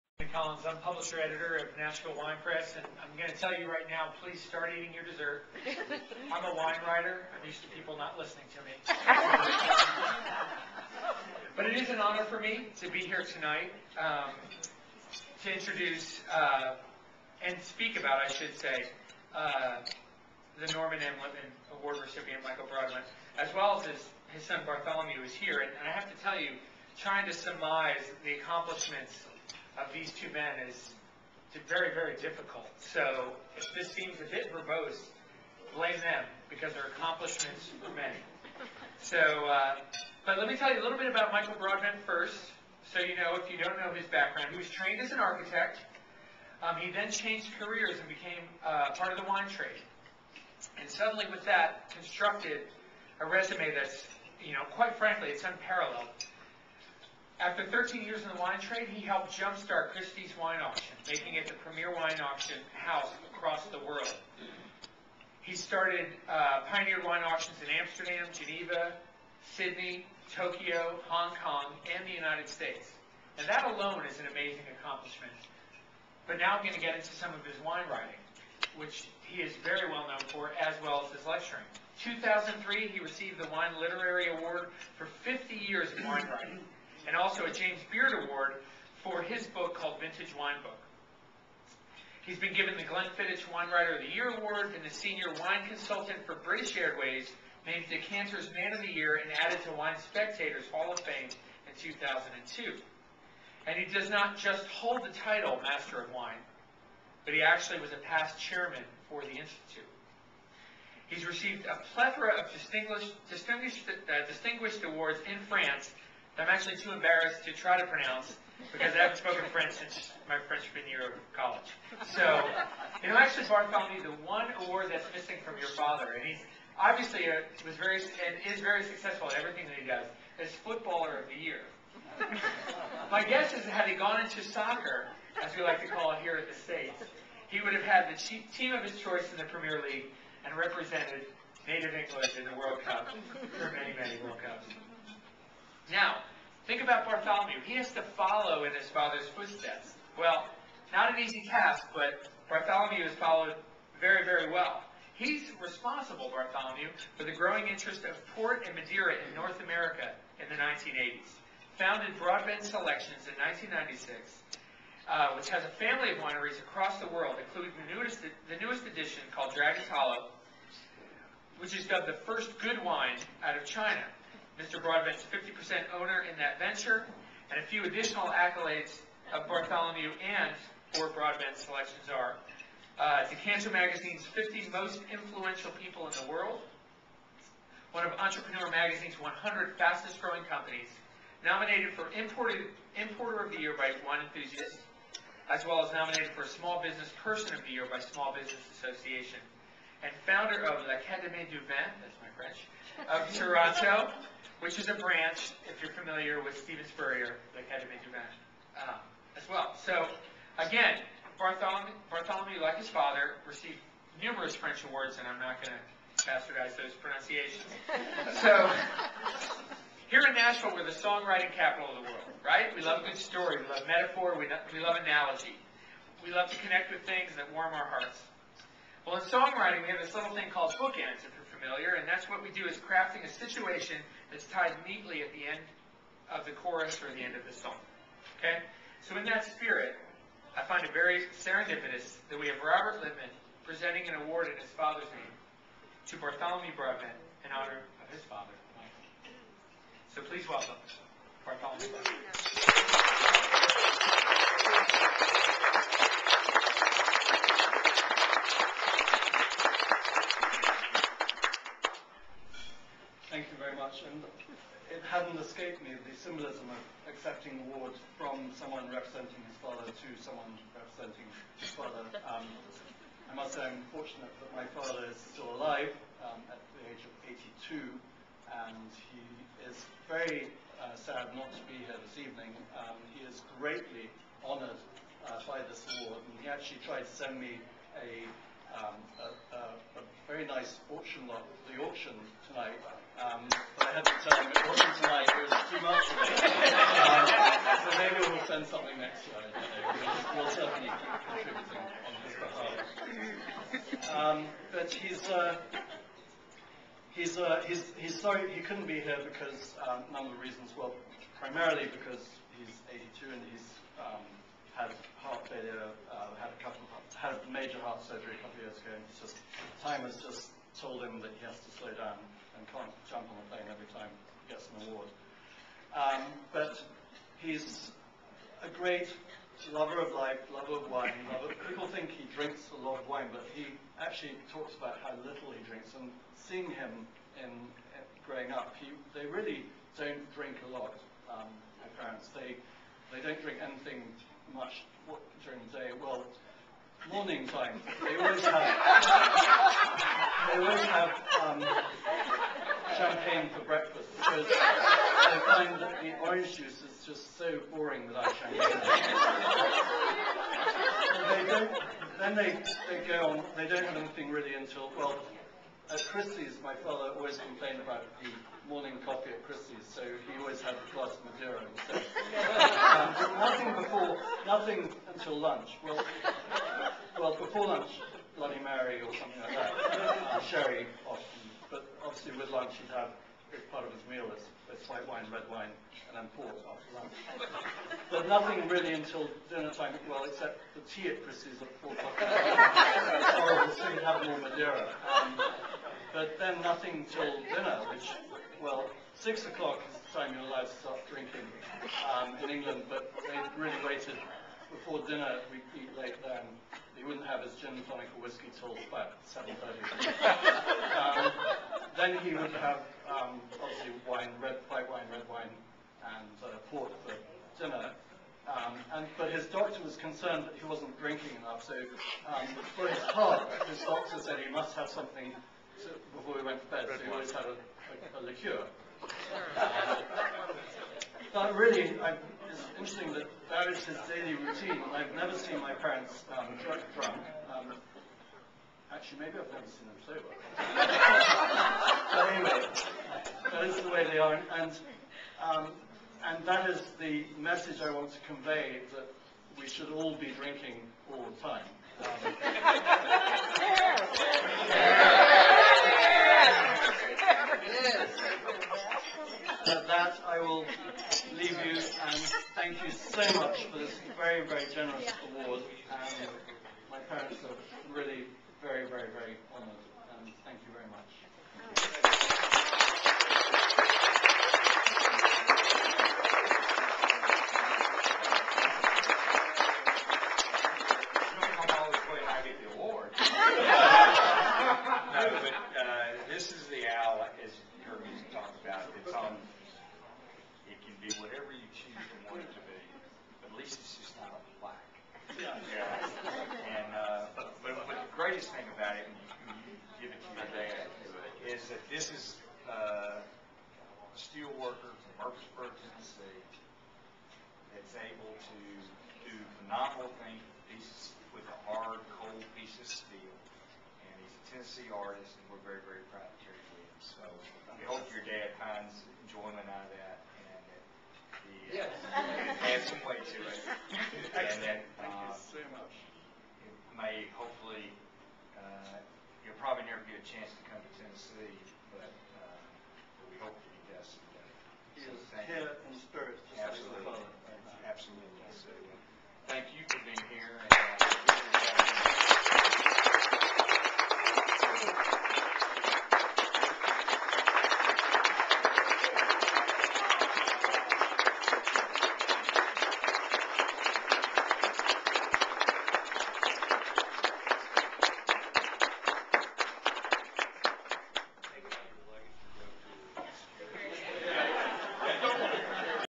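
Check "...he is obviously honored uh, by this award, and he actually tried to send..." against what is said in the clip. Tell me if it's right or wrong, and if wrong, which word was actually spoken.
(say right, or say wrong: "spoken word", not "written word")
wrong: "greatly", not "obviously".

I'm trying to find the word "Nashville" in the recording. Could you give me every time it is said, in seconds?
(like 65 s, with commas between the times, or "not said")
1 s, 220 s.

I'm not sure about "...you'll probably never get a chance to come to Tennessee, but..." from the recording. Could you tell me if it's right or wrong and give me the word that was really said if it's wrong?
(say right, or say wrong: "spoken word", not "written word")
right.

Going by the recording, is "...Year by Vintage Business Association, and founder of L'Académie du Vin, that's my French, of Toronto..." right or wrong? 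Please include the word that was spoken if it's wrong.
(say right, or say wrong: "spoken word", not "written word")
wrong: "Small", not "Vintage".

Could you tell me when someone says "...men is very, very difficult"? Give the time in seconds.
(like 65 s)
30 s.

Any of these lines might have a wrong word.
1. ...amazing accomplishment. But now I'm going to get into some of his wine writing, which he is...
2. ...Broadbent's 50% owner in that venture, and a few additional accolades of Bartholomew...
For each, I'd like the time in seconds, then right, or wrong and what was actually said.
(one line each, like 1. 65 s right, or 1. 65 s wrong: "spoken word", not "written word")
1. 74 s right
2. 174 s right.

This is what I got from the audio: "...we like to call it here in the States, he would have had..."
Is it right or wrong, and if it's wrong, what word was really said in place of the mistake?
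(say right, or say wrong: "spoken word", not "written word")
right.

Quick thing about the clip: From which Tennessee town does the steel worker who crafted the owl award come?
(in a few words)
Murfreesboro.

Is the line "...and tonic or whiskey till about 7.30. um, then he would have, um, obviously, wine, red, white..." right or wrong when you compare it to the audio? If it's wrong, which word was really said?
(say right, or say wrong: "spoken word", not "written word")
right.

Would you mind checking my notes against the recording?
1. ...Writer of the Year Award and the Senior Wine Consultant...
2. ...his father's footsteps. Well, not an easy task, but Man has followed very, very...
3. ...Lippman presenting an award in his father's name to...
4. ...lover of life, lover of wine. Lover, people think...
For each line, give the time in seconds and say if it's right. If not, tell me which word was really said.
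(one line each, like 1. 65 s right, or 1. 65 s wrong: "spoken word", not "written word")
1. 93 s right
2. 148 s wrong: "Bartholomew", not "Man"
3. 243 s right
4. 329 s right.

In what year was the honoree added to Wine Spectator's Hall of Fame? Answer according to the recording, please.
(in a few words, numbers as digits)
2002.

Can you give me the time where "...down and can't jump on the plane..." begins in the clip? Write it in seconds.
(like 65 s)
321 s.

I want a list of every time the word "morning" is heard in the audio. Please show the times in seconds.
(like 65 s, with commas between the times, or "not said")
347 s, 368 s.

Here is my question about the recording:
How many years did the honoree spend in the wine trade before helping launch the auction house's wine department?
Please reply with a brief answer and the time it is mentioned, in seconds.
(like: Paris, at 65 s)
13, at 57 s.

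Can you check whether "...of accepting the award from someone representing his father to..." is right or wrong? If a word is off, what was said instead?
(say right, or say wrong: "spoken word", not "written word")
right.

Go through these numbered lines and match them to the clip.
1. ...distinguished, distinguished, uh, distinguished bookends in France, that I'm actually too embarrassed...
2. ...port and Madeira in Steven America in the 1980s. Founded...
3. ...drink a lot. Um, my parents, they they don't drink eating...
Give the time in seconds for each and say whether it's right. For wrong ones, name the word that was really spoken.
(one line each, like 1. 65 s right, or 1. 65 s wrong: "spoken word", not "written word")
1. 112 s wrong: "awards", not "bookends"
2. 158 s wrong: "North", not "Steven"
3. 340 s wrong: "anything", not "eating".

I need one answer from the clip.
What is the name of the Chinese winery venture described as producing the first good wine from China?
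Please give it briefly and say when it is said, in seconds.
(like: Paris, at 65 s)
Dragon's Hollow, at 169 s.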